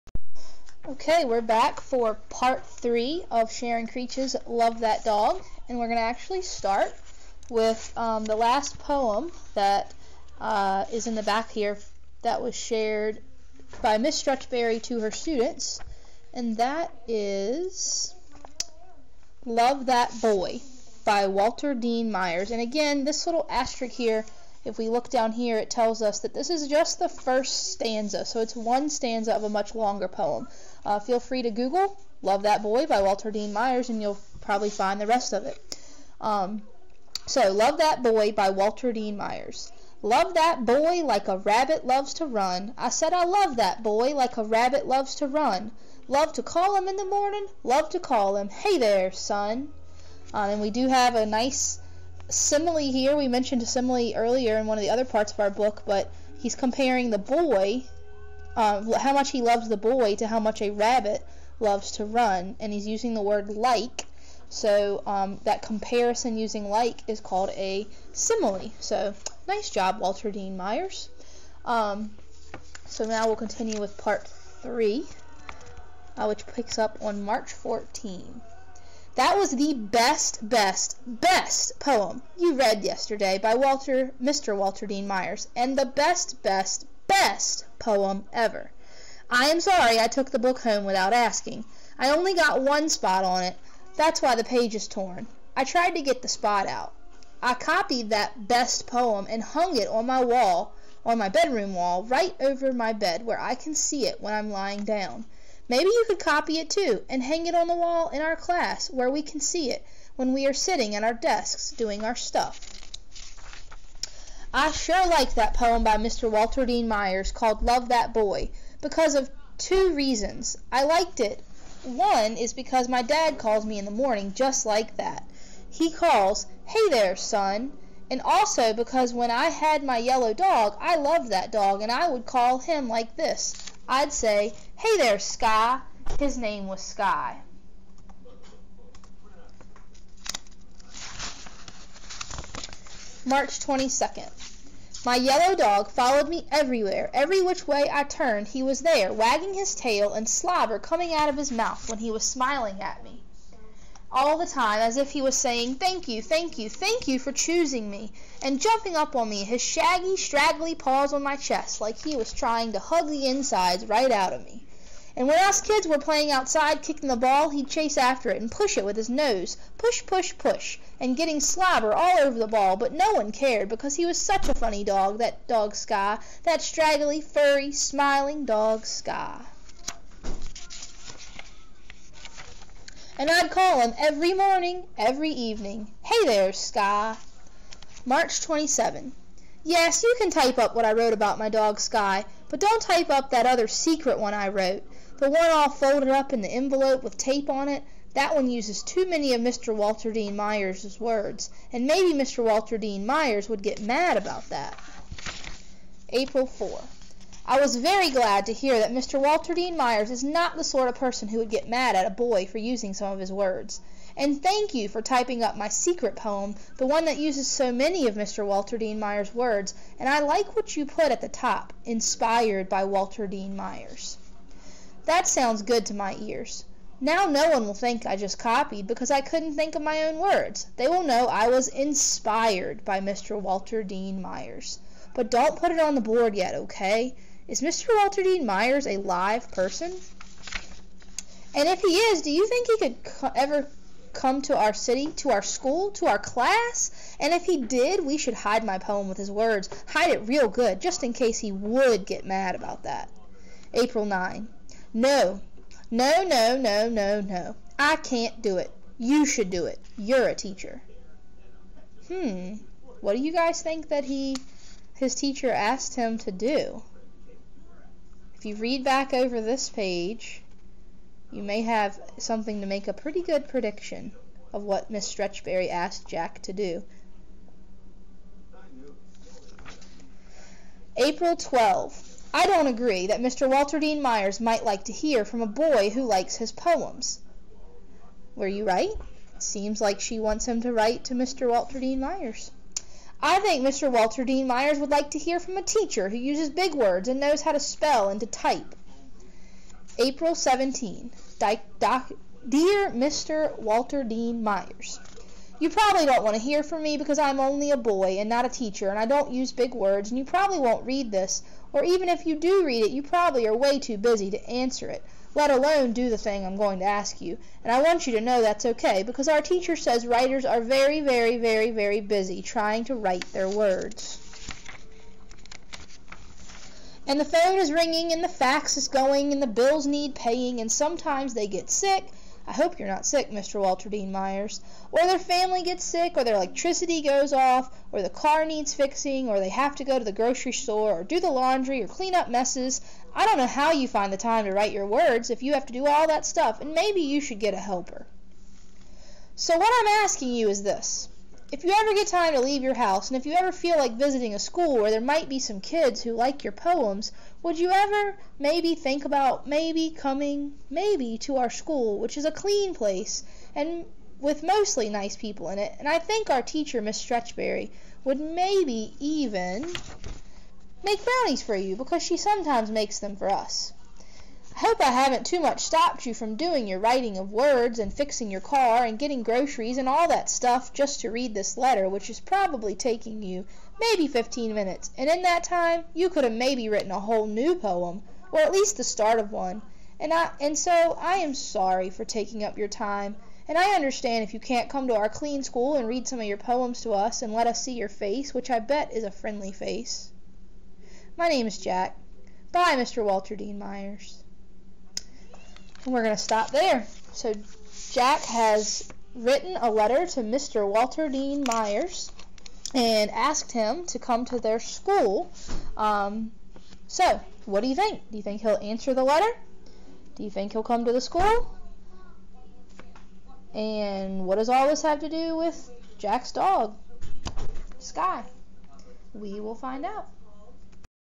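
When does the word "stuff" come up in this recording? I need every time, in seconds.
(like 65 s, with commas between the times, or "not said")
112 s, 346 s, 380 s.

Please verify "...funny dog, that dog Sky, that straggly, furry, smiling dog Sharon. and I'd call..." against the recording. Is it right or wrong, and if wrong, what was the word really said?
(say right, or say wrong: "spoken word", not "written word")
wrong: "Sky", not "Sharon".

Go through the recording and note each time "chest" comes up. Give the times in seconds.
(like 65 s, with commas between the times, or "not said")
161 s.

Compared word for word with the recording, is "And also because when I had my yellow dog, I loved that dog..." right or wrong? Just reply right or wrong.
right.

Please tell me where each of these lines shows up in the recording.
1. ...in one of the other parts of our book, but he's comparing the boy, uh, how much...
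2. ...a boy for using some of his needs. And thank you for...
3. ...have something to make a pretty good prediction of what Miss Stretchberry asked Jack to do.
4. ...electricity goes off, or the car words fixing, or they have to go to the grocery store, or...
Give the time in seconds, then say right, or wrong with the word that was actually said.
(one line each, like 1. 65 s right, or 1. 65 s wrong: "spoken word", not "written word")
1. 54 s right
2. 212 s wrong: "words", not "needs"
3. 271 s right
4. 336 s wrong: "needs", not "words".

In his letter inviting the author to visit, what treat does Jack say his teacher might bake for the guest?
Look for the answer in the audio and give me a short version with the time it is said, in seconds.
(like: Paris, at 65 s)
Brownies, at 371 s.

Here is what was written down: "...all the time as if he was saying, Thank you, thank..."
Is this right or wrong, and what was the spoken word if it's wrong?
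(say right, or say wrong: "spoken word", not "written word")
right.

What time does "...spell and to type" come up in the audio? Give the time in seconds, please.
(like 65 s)
297 s.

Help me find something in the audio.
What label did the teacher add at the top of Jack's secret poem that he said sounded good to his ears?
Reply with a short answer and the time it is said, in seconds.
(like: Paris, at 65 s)
Inspired by Walter Dean Myers, at 221 s.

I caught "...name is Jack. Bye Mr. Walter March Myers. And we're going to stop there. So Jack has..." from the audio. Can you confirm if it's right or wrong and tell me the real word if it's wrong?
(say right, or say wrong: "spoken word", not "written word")
wrong: "Dean", not "March".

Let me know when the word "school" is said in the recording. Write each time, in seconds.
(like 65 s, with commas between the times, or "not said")
245 s, 354 s, 361 s, 395 s, 414 s, 421 s.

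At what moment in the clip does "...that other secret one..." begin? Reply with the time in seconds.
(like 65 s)
193 s.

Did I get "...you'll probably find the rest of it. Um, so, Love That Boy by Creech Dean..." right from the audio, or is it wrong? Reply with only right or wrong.
wrong.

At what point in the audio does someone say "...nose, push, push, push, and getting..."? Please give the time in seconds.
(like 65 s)
169 s.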